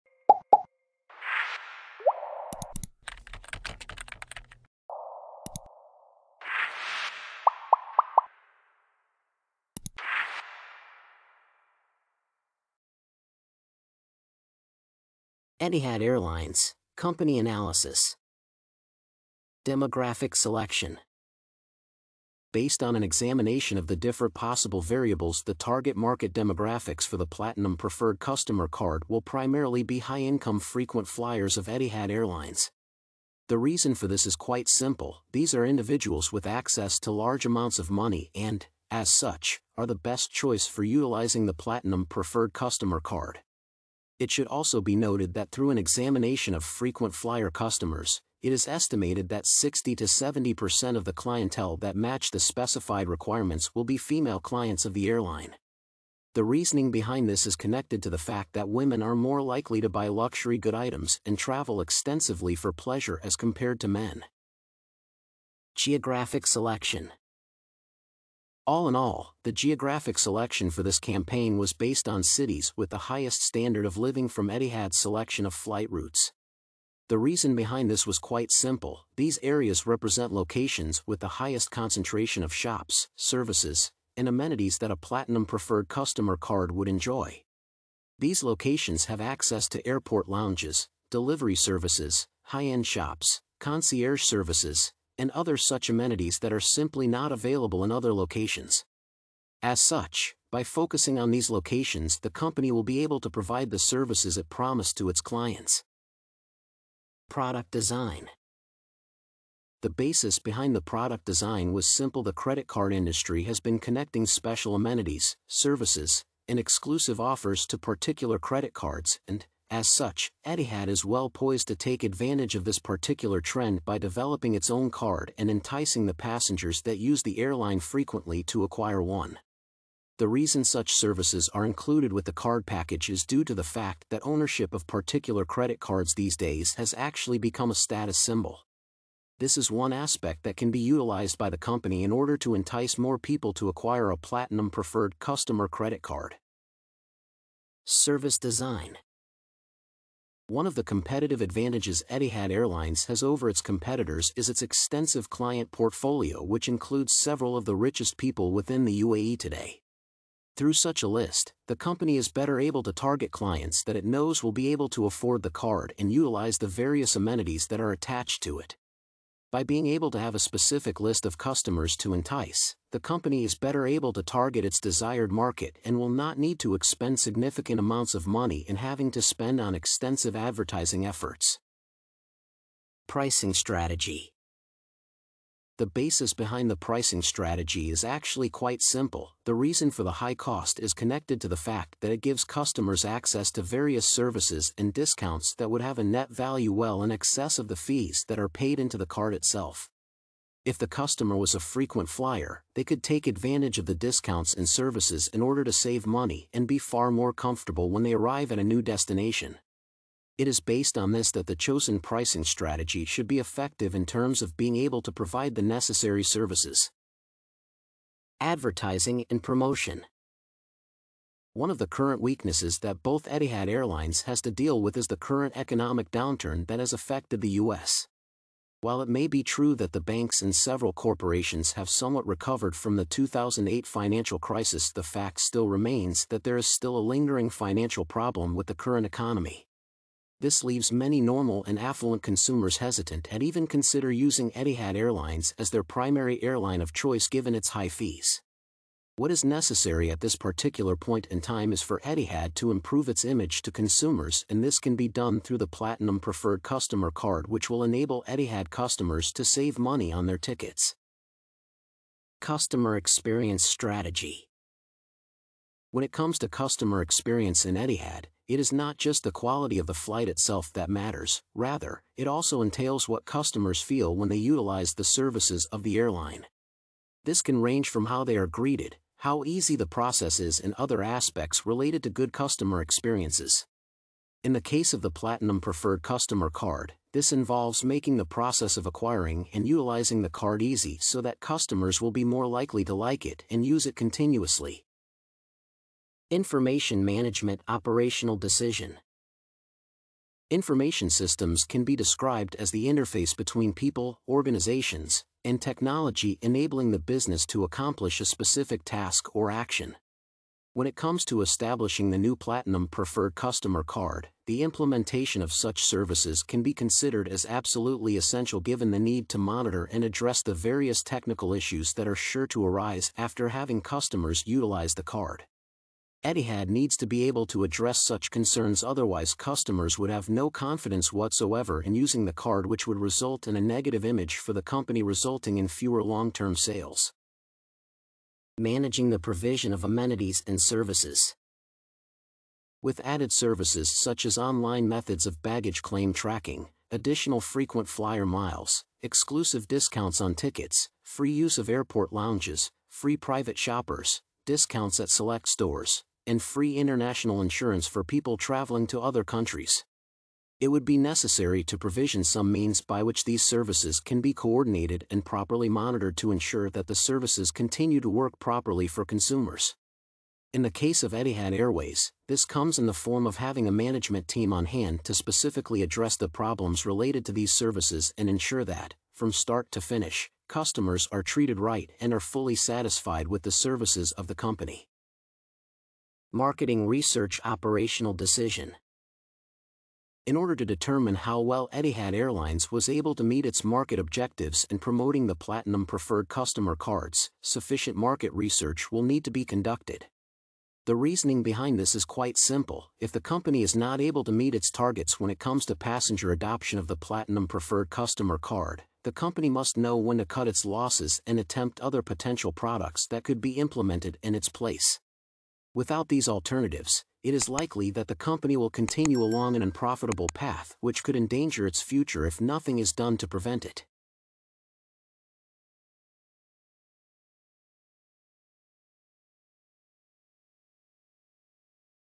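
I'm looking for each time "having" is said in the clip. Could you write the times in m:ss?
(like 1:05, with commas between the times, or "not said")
2:58, 5:23, 6:13.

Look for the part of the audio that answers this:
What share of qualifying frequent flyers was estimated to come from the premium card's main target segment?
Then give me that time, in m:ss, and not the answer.
0:49.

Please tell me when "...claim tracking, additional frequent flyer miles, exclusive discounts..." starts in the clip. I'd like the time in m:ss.
5:45.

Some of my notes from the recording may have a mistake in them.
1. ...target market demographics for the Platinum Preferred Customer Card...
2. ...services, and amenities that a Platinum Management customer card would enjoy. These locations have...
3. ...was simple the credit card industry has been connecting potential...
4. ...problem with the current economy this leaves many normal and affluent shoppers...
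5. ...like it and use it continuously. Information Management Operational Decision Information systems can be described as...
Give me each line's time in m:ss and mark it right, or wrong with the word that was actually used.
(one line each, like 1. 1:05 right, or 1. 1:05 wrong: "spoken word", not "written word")
1. 0:25 right
2. 1:23 wrong: "Preferred", not "Management"
3. 1:51 wrong: "special", not "potential"
4. 3:58 wrong: "consumers", not "shoppers"
5. 4:52 right.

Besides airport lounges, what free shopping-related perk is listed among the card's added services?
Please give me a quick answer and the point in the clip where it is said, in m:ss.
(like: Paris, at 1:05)
Free private shoppers, at 5:52.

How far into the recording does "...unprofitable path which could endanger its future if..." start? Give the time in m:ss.
6:59.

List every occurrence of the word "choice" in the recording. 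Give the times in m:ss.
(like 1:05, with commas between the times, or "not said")
0:40, 4:06.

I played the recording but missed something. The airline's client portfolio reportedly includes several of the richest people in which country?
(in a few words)
UAE.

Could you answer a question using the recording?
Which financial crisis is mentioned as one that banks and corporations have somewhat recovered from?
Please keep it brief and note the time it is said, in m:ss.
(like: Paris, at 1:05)
2008 financial crisis, at 3:53.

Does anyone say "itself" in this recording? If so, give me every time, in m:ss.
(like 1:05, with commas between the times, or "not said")
3:19, 4:30.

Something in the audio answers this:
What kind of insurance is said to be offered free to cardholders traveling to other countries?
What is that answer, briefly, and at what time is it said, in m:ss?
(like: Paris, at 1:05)
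International insurance, at 5:56.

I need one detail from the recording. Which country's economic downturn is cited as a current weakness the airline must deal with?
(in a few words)
U.S.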